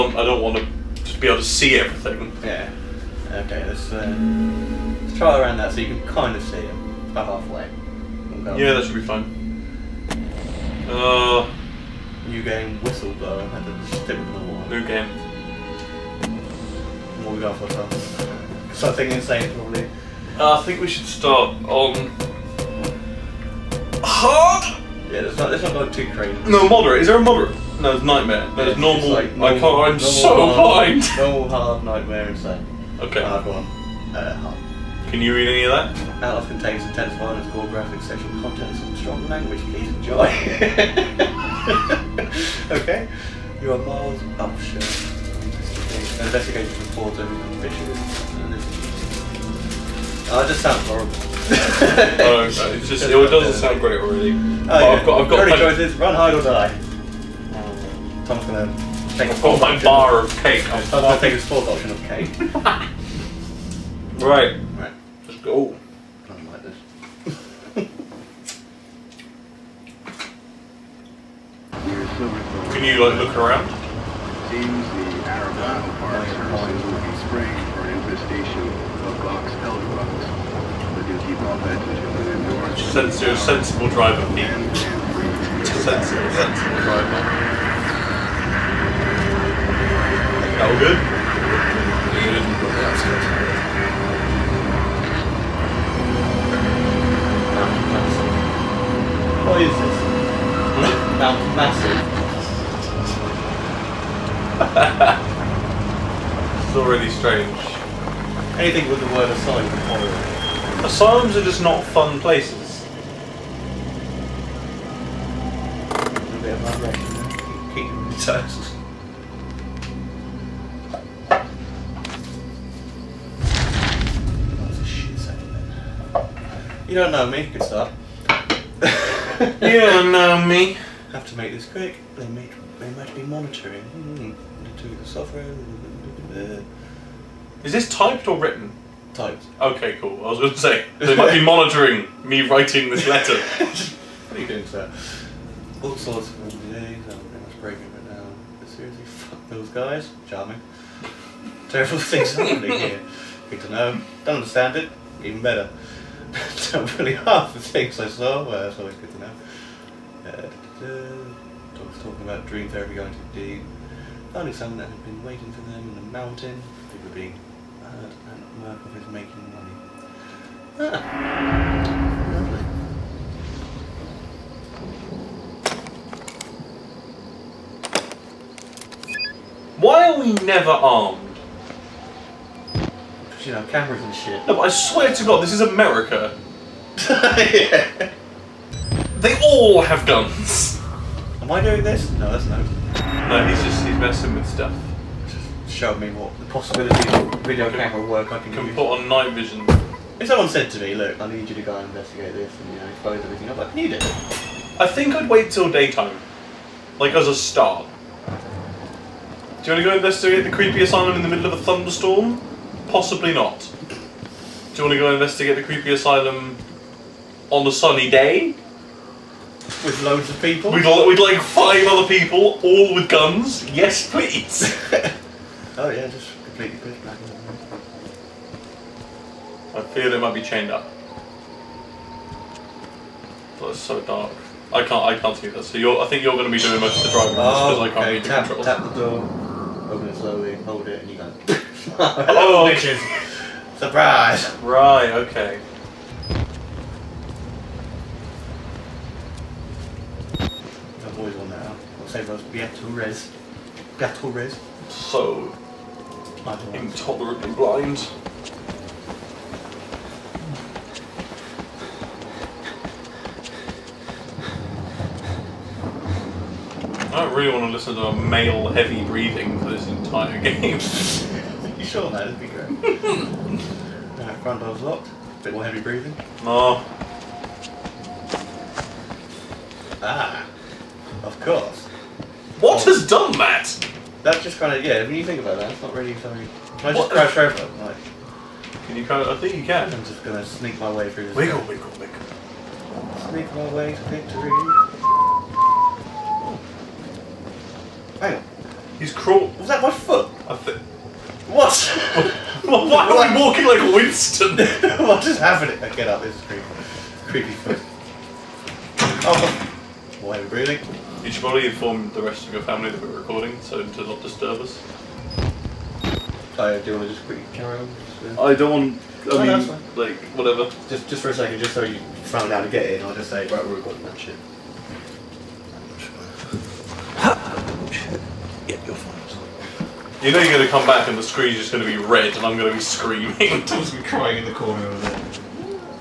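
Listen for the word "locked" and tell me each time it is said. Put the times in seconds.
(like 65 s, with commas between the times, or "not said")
274 s.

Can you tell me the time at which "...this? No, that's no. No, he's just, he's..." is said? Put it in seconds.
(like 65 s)
191 s.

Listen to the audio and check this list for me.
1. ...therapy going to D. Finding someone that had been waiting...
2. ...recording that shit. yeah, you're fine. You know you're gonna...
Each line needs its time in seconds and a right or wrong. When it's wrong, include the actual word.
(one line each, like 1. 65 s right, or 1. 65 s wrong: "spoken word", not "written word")
1. 162 s right
2. 323 s right.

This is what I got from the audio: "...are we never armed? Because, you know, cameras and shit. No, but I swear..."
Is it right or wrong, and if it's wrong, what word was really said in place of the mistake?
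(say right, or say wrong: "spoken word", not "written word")
right.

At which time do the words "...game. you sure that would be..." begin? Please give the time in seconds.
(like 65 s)
270 s.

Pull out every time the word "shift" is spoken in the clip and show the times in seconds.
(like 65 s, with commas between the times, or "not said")
not said.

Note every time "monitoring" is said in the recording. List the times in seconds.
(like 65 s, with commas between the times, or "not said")
133 s, 141 s.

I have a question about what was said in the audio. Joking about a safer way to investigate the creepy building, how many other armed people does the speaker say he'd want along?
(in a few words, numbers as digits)
5.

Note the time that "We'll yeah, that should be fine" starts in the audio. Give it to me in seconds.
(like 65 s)
8 s.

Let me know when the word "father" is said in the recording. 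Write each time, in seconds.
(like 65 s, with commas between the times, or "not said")
not said.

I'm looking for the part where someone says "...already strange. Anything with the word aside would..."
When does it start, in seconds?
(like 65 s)
106 s.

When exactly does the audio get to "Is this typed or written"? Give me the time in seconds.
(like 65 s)
137 s.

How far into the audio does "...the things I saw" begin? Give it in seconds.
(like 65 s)
157 s.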